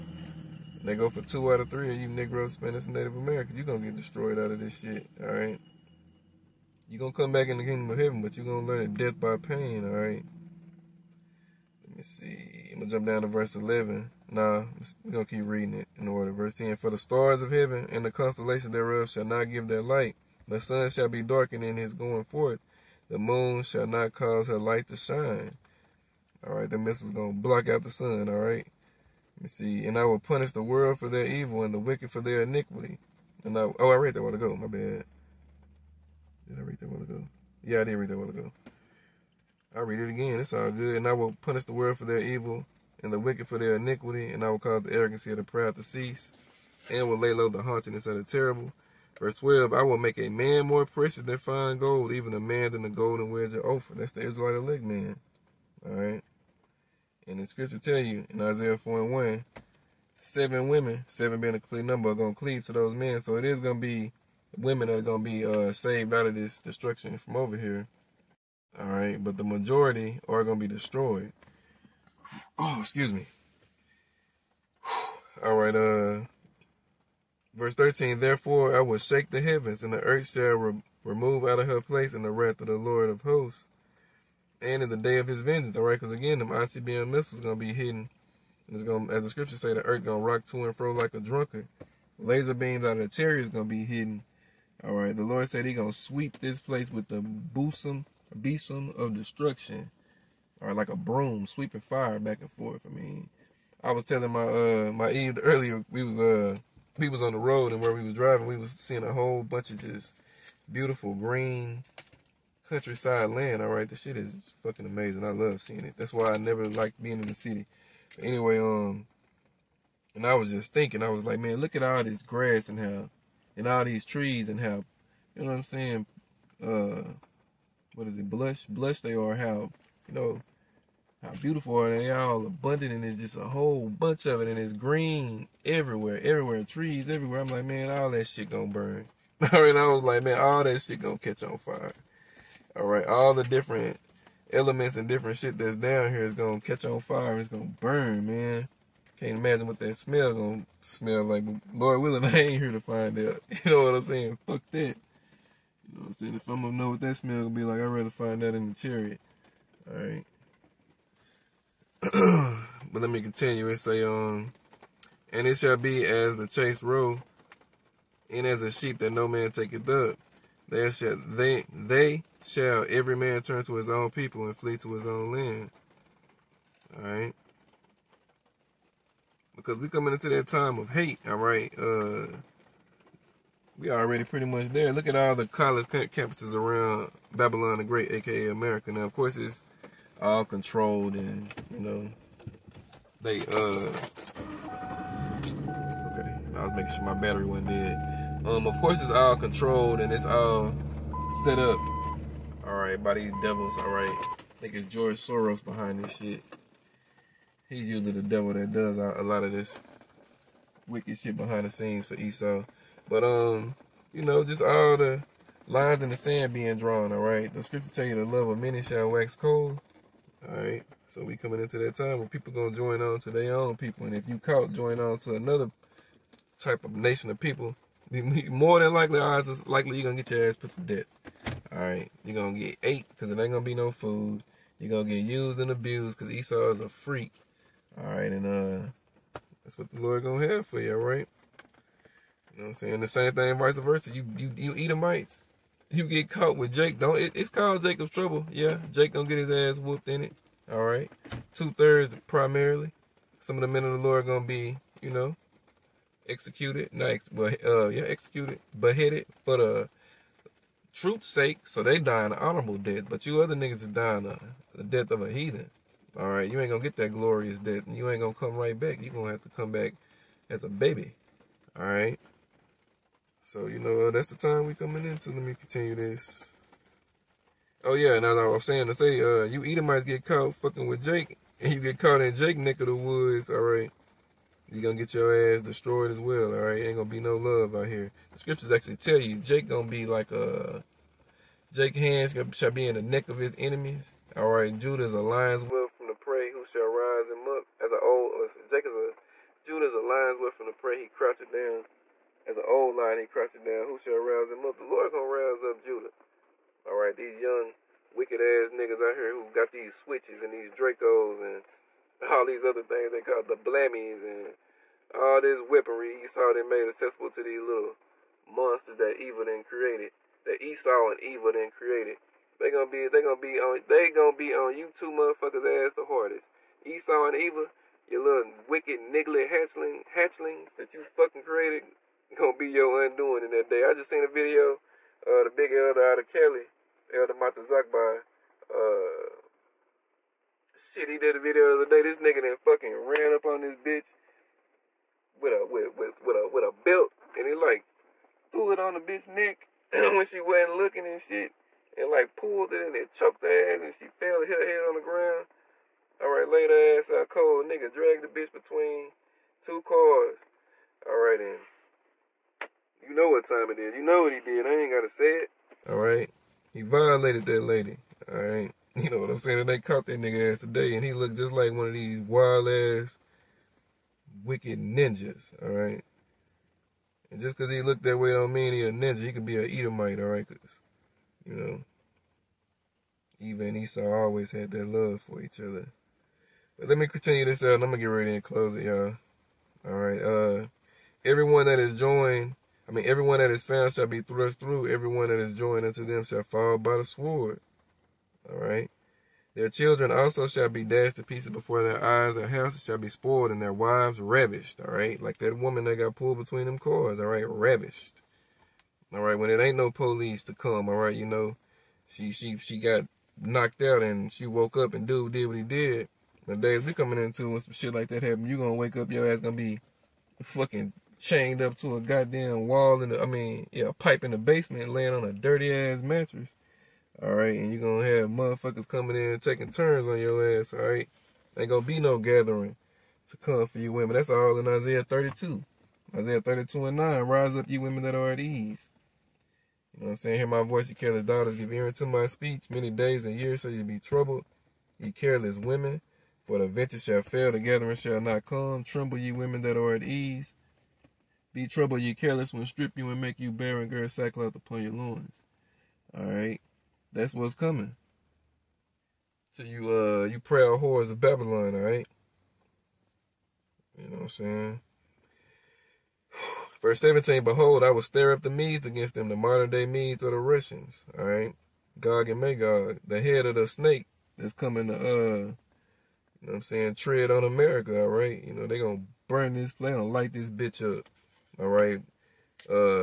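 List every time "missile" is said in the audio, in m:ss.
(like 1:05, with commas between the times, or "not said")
0:26, 1:27.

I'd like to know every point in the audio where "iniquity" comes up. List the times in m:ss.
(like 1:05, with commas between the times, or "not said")
0:32, 0:43.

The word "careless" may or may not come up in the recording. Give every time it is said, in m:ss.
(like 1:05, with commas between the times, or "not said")
7:20, 7:25, 7:32.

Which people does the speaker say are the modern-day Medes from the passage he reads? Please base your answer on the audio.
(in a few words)
the Russians.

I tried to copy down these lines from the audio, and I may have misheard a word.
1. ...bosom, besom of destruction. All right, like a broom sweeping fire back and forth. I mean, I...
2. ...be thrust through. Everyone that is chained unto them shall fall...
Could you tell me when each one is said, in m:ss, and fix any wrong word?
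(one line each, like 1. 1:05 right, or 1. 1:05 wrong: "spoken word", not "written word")
1. 1:37 right
2. 6:34 wrong: "joined", not "chained".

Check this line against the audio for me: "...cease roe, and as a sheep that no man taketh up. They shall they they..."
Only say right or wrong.
wrong.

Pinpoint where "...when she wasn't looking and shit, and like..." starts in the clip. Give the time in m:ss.
5:49.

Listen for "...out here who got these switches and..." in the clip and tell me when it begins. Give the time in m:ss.
5:09.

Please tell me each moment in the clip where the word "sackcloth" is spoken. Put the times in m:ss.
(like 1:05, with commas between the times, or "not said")
7:34.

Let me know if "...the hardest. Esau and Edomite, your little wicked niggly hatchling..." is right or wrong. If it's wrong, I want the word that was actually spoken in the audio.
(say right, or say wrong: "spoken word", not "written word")
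wrong: "Eva", not "Edomite".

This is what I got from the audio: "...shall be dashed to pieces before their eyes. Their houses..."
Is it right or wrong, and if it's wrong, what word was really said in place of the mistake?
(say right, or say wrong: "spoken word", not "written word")
right.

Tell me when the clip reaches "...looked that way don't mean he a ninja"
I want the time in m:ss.
6:17.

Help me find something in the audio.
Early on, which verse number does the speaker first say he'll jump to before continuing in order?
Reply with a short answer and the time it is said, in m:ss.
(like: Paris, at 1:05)
11, at 0:13.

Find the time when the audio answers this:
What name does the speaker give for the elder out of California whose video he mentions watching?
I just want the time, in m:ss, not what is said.
5:37.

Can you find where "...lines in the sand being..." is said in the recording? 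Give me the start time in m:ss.
3:35.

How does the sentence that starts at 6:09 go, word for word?
And they caught that nigga ass today, and he looked just like one of these wild ass, wicked ninjas.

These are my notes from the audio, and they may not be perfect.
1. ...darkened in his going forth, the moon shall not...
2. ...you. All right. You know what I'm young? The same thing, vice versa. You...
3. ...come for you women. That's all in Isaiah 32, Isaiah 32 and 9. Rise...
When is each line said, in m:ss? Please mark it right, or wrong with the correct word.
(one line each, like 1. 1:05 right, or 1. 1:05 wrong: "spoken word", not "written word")
1. 0:21 right
2. 4:00 wrong: "saying", not "young"
3. 7:13 right.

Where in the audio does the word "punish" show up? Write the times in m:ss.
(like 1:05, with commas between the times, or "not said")
0:30, 0:41.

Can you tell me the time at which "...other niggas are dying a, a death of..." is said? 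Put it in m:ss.
4:23.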